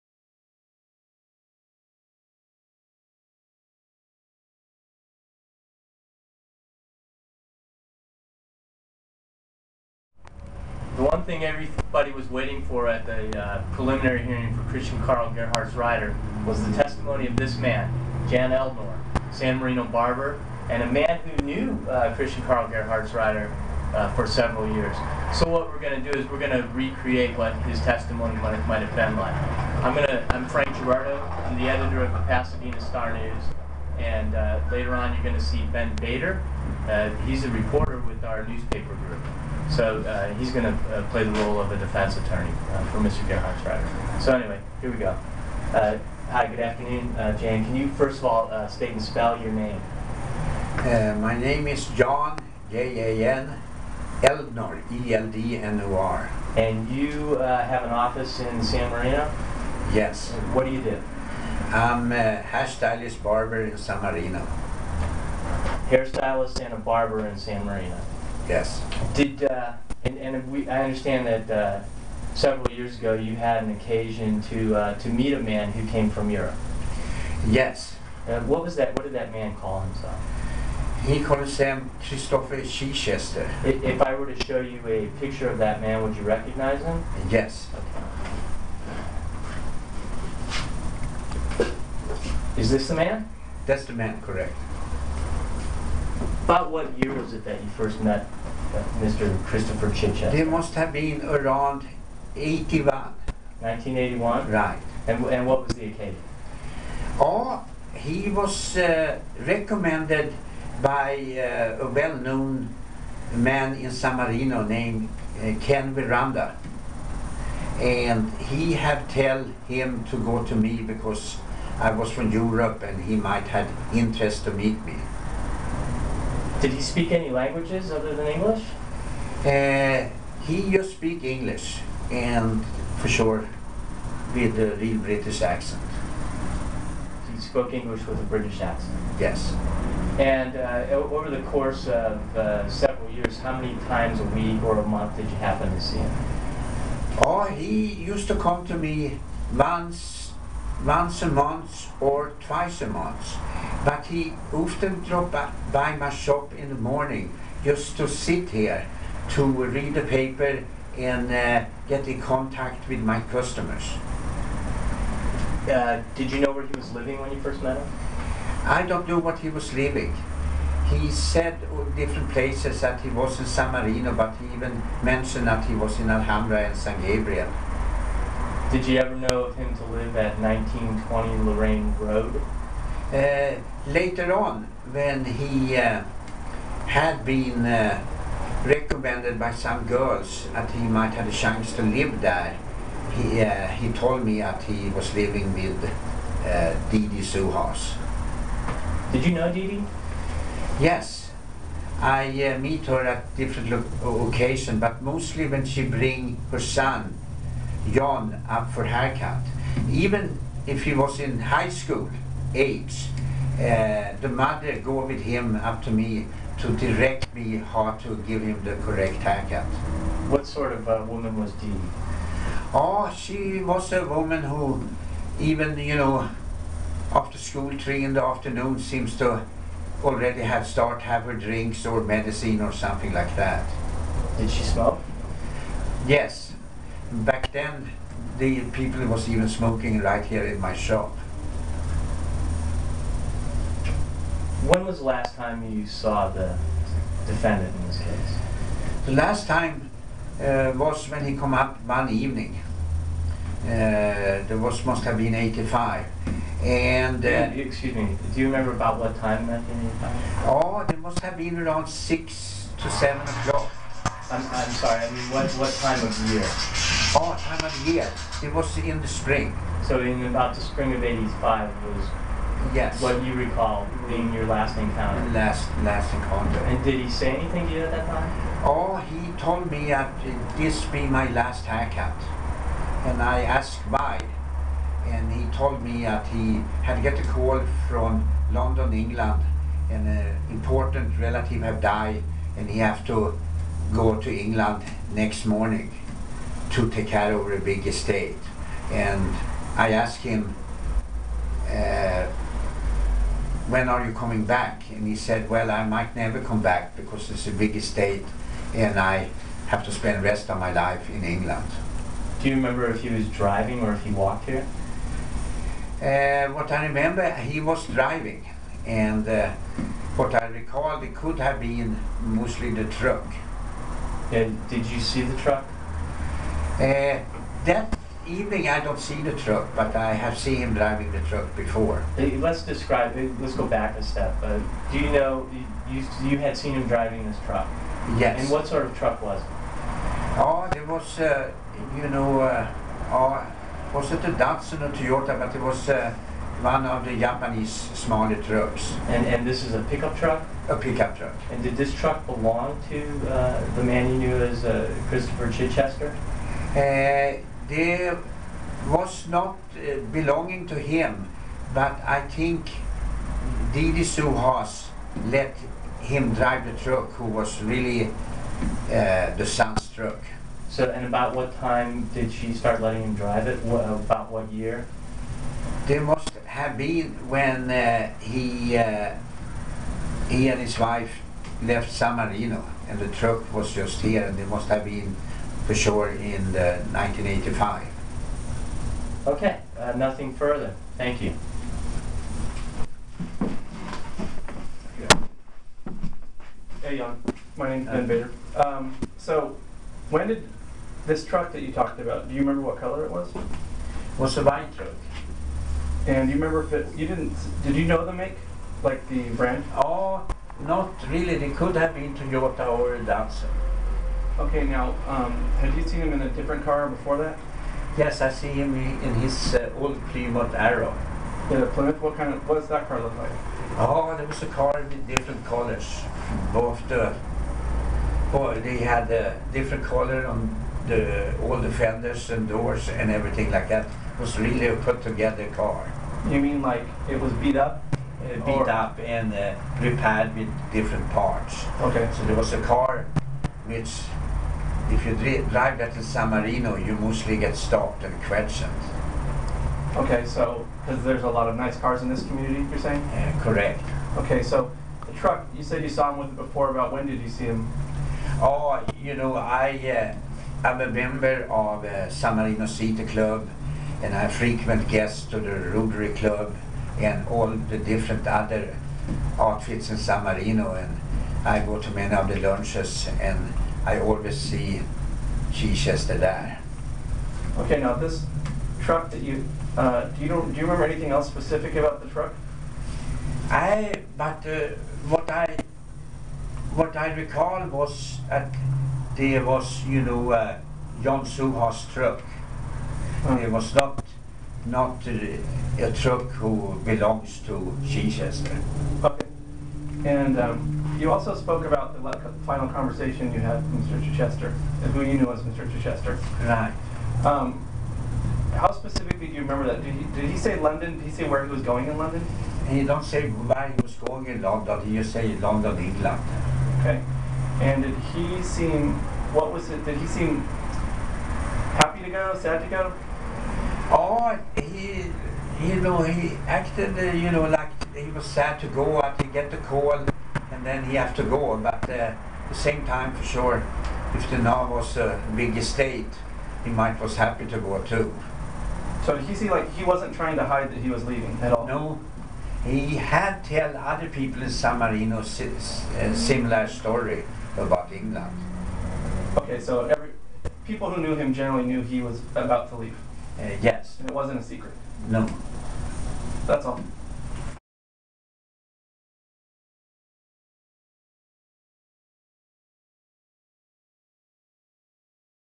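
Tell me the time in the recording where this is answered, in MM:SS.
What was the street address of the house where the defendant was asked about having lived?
03:00.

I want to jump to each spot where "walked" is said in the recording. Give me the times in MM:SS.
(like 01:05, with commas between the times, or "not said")
05:14.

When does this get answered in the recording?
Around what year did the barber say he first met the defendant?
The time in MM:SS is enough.
01:42.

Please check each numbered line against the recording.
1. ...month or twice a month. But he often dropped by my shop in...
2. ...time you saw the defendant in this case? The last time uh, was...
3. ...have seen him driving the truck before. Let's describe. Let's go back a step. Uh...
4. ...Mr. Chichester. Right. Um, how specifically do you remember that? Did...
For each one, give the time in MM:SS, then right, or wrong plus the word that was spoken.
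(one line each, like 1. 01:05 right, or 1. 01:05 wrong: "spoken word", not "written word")
1. 02:31 right
2. 04:05 right
3. 05:30 right
4. 08:25 right.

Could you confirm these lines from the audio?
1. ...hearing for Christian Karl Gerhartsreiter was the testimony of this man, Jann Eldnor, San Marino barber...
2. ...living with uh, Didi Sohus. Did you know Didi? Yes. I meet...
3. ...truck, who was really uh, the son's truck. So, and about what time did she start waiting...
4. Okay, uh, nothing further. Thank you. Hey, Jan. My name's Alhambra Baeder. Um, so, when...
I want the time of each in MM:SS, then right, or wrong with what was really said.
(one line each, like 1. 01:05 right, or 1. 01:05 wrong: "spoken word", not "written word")
1. 00:14 right
2. 03:15 right
3. 06:06 wrong: "letting", not "waiting"
4. 06:29 wrong: "Ben", not "Alhambra".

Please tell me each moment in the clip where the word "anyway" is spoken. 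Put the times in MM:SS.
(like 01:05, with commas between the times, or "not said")
00:44.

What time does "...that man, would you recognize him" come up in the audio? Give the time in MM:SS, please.
01:25.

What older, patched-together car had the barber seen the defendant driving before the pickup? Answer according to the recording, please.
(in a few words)
Plymouth Arrow.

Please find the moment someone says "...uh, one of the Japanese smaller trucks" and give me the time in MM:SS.
05:45.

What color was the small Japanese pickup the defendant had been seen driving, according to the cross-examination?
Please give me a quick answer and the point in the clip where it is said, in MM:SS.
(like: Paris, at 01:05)
white, at 06:44.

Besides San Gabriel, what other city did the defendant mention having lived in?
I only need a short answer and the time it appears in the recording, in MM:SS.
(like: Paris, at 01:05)
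Alhambra, at 02:56.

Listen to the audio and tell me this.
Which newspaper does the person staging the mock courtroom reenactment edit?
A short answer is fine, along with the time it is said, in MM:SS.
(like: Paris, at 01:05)
Pasadena Star News, at 00:32.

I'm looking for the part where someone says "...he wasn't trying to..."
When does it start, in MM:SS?
08:59.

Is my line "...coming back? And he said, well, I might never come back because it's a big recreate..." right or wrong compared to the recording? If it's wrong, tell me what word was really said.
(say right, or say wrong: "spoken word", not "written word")
wrong: "estate", not "recreate".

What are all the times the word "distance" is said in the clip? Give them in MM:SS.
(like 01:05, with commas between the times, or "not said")
not said.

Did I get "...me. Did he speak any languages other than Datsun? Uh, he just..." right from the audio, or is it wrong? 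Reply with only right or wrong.
wrong.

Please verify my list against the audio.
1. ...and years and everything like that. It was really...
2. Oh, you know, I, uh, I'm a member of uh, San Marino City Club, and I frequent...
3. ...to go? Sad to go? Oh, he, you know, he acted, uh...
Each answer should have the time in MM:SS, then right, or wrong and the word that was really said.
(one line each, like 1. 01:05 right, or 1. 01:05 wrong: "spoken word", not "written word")
1. 07:12 wrong: "doors", not "years"
2. 07:38 right
3. 08:42 right.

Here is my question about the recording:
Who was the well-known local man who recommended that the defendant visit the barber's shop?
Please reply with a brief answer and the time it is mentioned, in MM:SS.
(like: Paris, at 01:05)
Ken Veranda, at 01:55.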